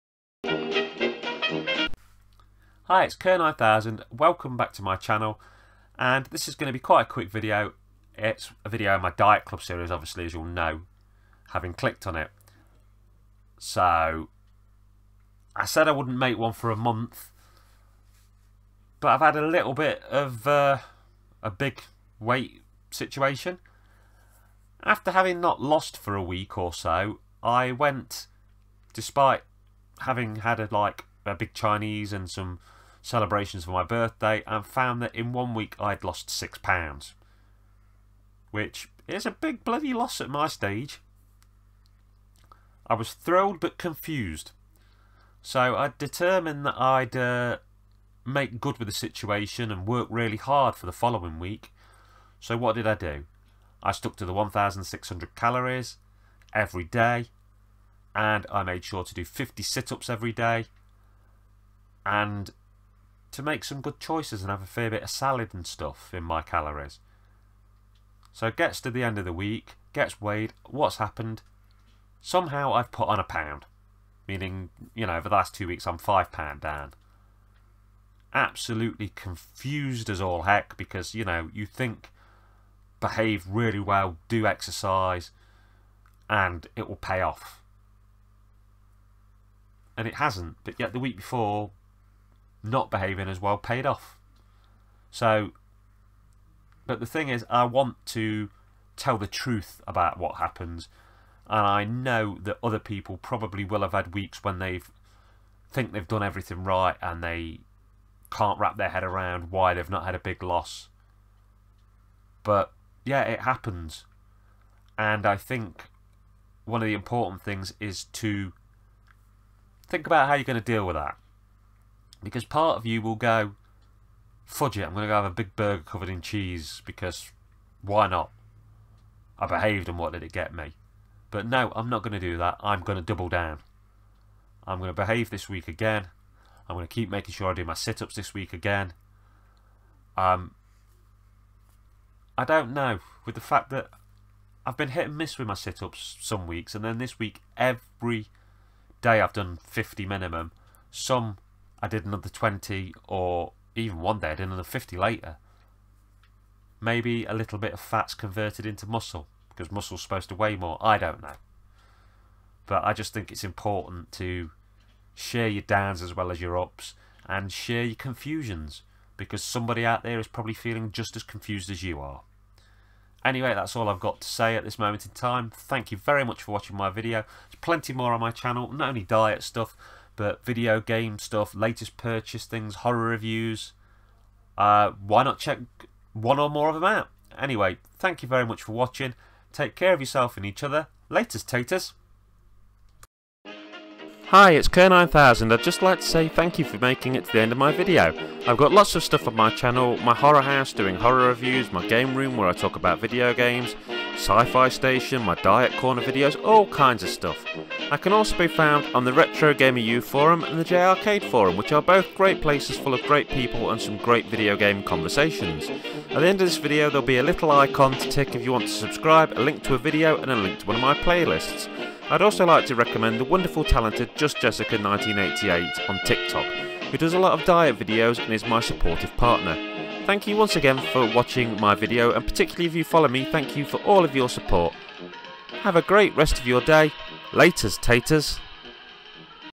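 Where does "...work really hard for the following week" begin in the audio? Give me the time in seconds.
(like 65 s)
49 s.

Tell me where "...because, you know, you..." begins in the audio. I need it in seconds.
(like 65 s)
80 s.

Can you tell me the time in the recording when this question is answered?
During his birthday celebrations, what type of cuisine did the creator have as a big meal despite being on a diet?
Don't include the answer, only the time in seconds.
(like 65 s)
31 s.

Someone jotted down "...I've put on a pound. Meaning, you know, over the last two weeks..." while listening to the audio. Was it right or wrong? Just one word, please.
right.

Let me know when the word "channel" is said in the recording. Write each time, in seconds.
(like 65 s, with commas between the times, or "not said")
4 s, 178 s, 199 s.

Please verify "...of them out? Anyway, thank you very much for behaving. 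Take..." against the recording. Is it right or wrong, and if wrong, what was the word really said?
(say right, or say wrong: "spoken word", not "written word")
wrong: "watching", not "behaving".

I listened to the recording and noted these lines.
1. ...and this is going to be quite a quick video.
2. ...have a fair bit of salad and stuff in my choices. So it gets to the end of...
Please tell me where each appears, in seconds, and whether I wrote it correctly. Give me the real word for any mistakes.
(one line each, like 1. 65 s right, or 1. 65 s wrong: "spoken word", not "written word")
1. 5 s right
2. 64 s wrong: "calories", not "choices".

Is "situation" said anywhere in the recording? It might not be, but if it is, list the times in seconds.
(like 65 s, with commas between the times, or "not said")
22 s, 48 s.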